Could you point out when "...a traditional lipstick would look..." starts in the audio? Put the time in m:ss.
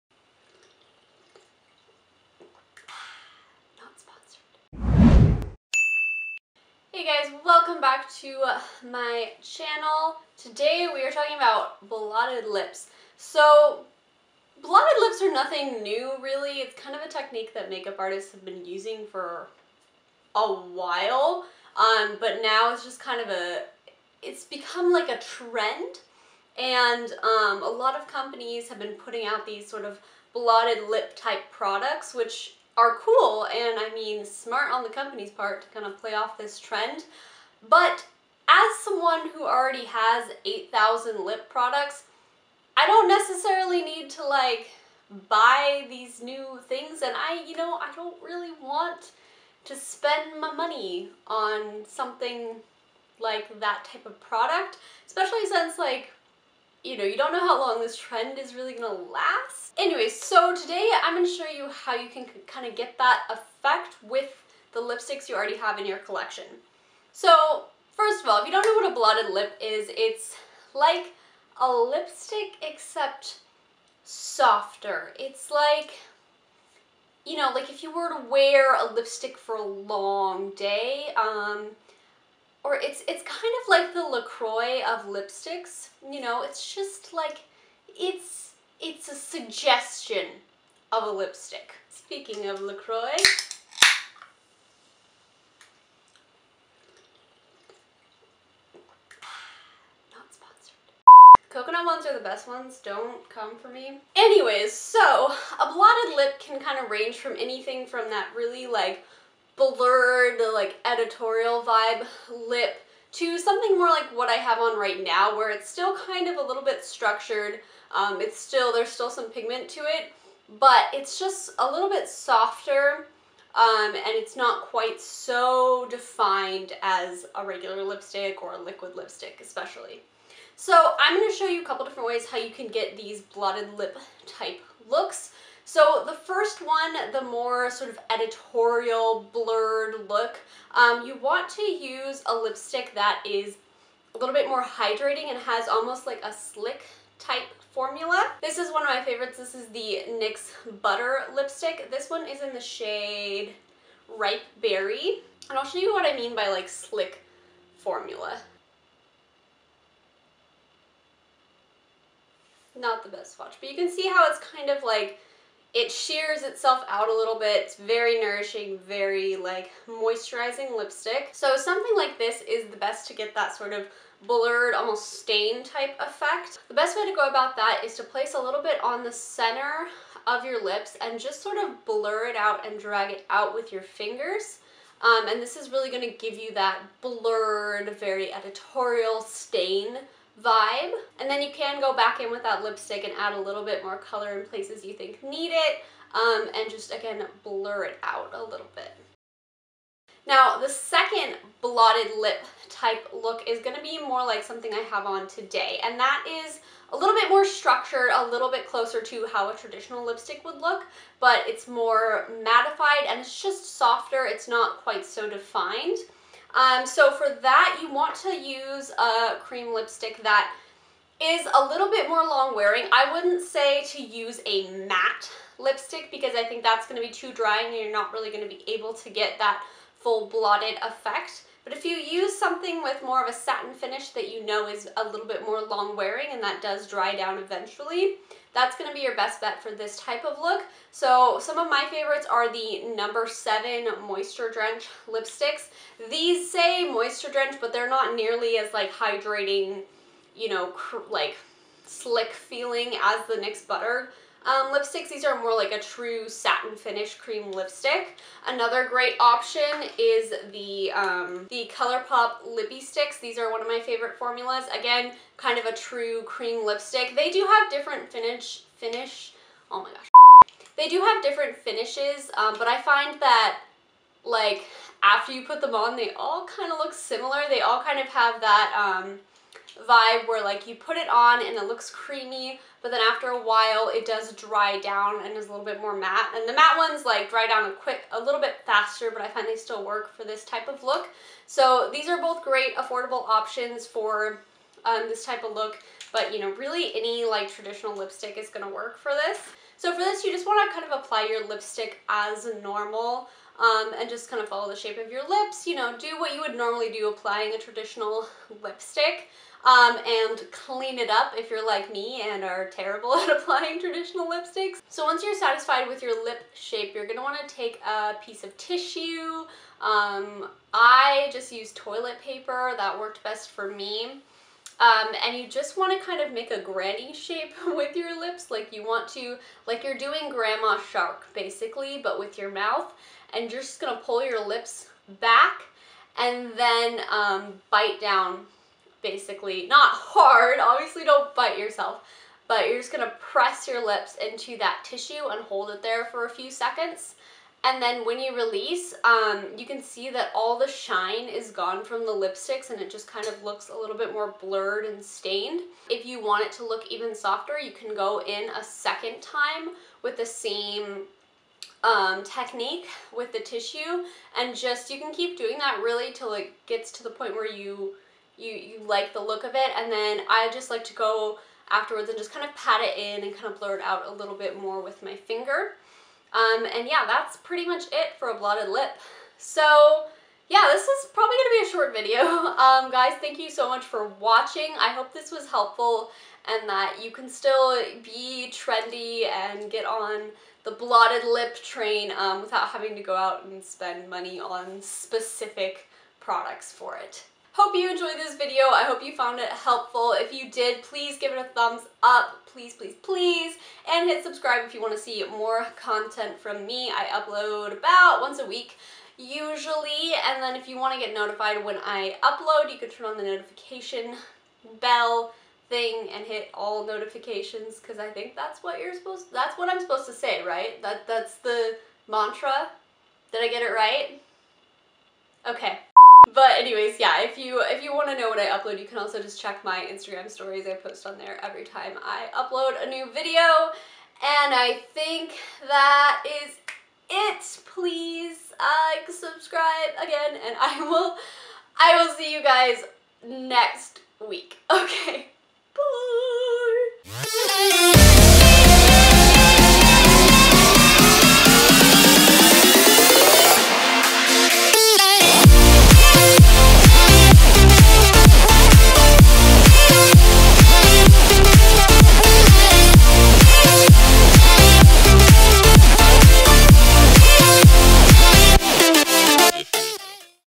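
3:29.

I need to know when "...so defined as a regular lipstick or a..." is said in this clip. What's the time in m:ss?
2:05.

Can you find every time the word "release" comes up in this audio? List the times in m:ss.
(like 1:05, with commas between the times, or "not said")
5:48.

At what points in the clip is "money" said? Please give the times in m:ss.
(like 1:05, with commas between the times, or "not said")
0:50, 6:34.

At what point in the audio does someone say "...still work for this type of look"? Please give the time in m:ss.
4:49.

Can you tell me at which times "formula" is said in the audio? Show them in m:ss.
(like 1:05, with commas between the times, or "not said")
2:27, 2:37, 4:24.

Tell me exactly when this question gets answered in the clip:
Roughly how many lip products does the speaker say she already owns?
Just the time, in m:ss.
0:40.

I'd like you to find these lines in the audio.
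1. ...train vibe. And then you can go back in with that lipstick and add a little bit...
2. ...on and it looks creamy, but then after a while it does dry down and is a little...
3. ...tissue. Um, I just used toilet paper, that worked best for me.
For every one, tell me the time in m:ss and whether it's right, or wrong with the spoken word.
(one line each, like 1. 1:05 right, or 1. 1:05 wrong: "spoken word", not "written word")
1. 3:09 wrong: "stain", not "train"
2. 4:41 right
3. 5:18 right.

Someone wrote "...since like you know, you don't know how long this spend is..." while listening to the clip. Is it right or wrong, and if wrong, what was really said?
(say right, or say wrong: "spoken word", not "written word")
wrong: "trend", not "spend".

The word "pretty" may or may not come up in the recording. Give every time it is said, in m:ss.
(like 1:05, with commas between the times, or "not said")
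6:17.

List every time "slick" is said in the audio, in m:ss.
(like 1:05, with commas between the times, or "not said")
2:26, 2:36, 4:11.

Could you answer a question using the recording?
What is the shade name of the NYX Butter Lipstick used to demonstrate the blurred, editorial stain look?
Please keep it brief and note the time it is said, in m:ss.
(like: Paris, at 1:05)
Ripe Berry, at 2:34.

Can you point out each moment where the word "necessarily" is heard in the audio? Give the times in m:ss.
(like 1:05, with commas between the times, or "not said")
0:43.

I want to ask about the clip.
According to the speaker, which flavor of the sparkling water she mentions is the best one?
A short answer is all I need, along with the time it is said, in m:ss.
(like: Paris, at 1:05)
Coconut, at 1:41.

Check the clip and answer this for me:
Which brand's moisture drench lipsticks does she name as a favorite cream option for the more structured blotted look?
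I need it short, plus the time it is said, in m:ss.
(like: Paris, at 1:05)
No7, at 4:02.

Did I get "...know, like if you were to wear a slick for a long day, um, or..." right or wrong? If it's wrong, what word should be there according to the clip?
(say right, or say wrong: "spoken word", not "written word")
wrong: "lipstick", not "slick".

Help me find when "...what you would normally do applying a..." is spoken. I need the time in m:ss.
5:06.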